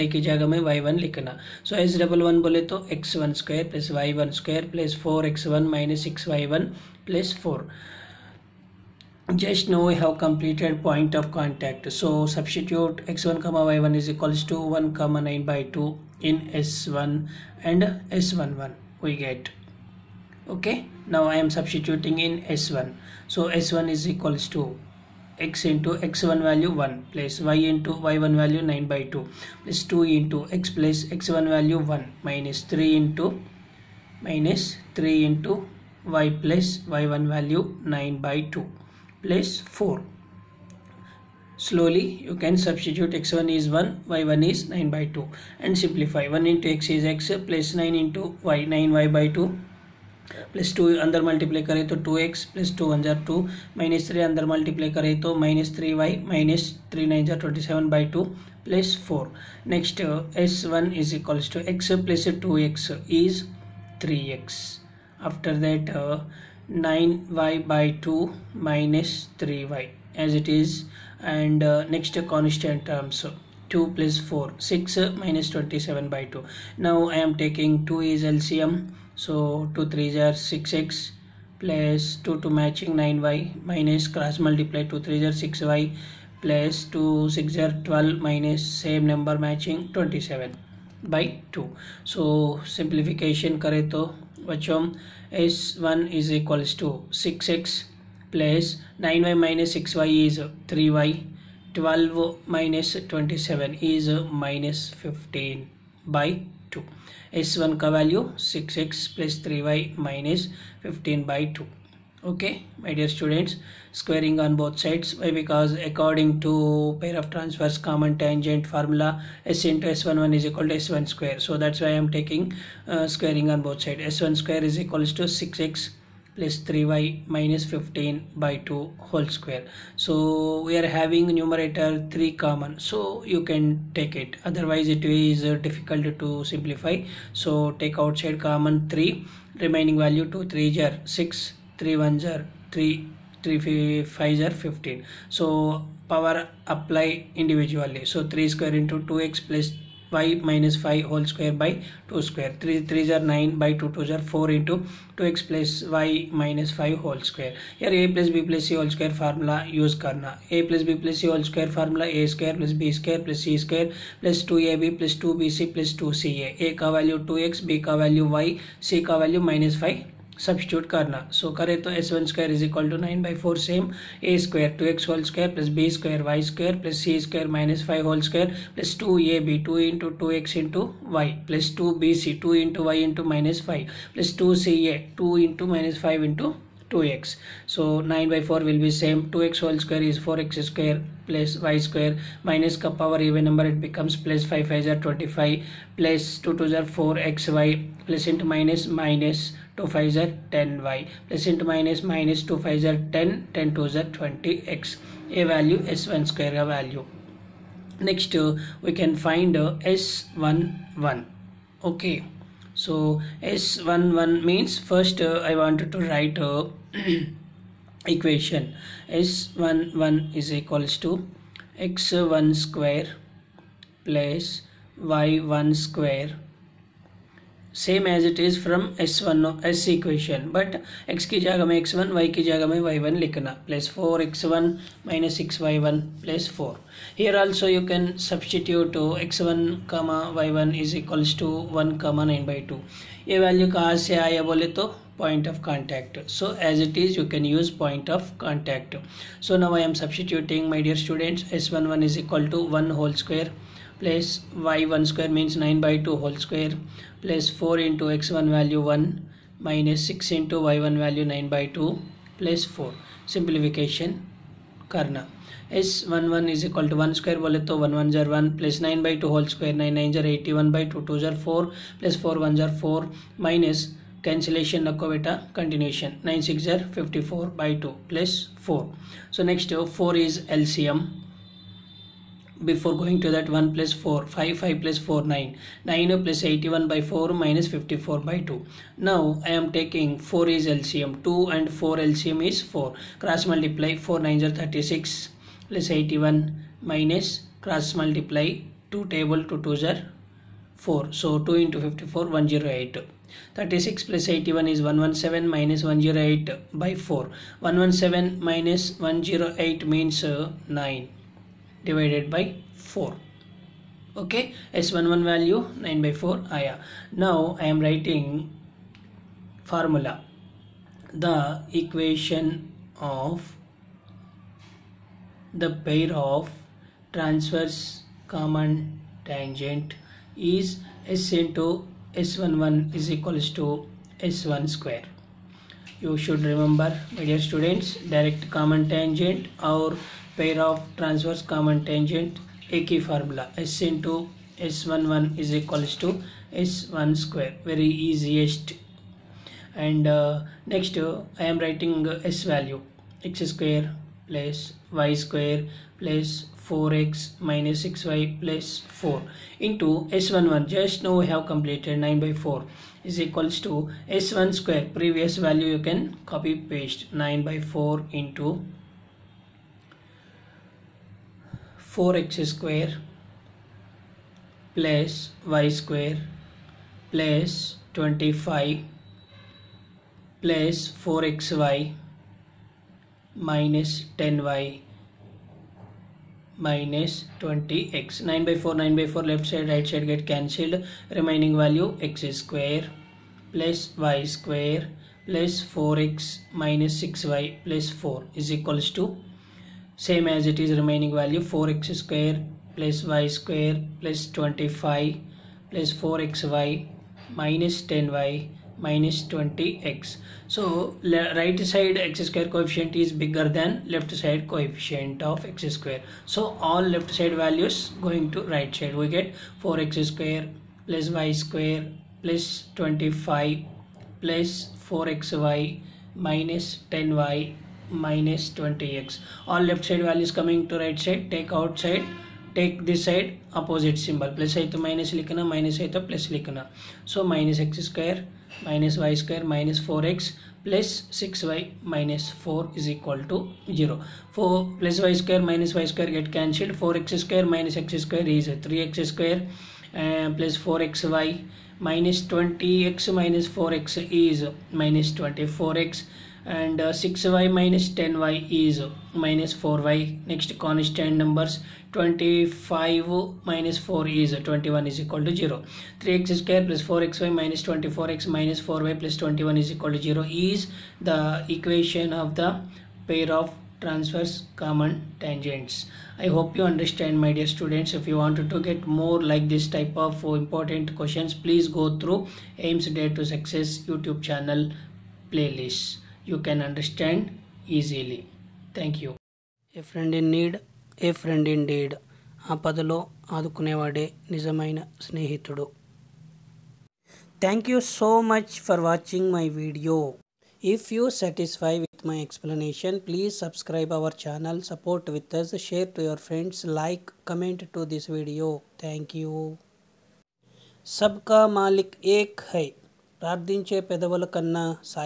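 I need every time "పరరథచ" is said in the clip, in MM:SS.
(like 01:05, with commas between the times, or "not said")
08:33.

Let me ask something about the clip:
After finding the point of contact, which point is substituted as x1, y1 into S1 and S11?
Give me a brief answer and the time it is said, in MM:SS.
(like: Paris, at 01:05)
(1, 9/2), at 00:14.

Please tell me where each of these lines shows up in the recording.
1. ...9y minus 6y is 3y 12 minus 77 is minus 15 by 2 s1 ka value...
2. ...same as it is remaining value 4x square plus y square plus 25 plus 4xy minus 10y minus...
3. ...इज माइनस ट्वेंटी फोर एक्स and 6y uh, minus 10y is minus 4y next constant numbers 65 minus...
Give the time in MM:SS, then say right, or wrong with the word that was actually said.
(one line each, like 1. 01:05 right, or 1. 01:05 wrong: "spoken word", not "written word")
1. 01:39 wrong: "27", not "77"
2. 06:40 right
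3. 07:33 wrong: "25", not "65".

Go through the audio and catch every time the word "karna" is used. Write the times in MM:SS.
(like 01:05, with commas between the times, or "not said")
04:24.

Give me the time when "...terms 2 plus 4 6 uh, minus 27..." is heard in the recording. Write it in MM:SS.
01:12.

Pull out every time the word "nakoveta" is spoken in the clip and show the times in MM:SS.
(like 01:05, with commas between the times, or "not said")
04:34.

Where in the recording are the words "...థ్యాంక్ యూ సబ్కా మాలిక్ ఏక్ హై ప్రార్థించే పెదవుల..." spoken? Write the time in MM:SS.
08:28.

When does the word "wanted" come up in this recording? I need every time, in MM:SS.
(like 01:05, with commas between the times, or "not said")
03:35, 07:58.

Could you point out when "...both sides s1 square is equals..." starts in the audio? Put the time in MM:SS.
02:03.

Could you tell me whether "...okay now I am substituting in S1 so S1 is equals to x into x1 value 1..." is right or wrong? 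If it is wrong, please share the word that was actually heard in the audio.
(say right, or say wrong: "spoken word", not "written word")
right.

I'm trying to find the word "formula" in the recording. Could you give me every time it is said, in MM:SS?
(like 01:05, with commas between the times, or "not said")
01:58, 05:19, 05:43.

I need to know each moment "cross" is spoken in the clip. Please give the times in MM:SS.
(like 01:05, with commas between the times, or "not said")
01:24.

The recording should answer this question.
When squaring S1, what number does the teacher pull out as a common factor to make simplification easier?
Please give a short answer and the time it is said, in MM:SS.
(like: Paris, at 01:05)
3, at 02:12.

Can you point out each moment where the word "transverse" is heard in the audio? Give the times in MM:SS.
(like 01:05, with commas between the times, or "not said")
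01:57, 05:27, 05:40, 07:53.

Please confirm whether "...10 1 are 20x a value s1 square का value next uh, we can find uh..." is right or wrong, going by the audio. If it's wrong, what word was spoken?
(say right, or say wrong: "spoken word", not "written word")
wrong: "2", not "1".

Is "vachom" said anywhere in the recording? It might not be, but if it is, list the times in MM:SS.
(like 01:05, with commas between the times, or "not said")
01:34.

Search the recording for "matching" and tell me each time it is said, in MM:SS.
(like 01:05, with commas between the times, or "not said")
01:22, 01:29.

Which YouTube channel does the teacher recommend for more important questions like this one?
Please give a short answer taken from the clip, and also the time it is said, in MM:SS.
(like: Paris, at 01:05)
Aims Dare to Success, at 08:02.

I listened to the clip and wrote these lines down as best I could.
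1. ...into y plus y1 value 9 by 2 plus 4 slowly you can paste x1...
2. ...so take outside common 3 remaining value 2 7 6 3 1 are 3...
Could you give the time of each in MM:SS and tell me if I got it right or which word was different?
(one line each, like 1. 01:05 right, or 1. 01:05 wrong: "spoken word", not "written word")
1. 00:35 wrong: "substitute", not "paste"
2. 02:17 wrong: "3", not "7".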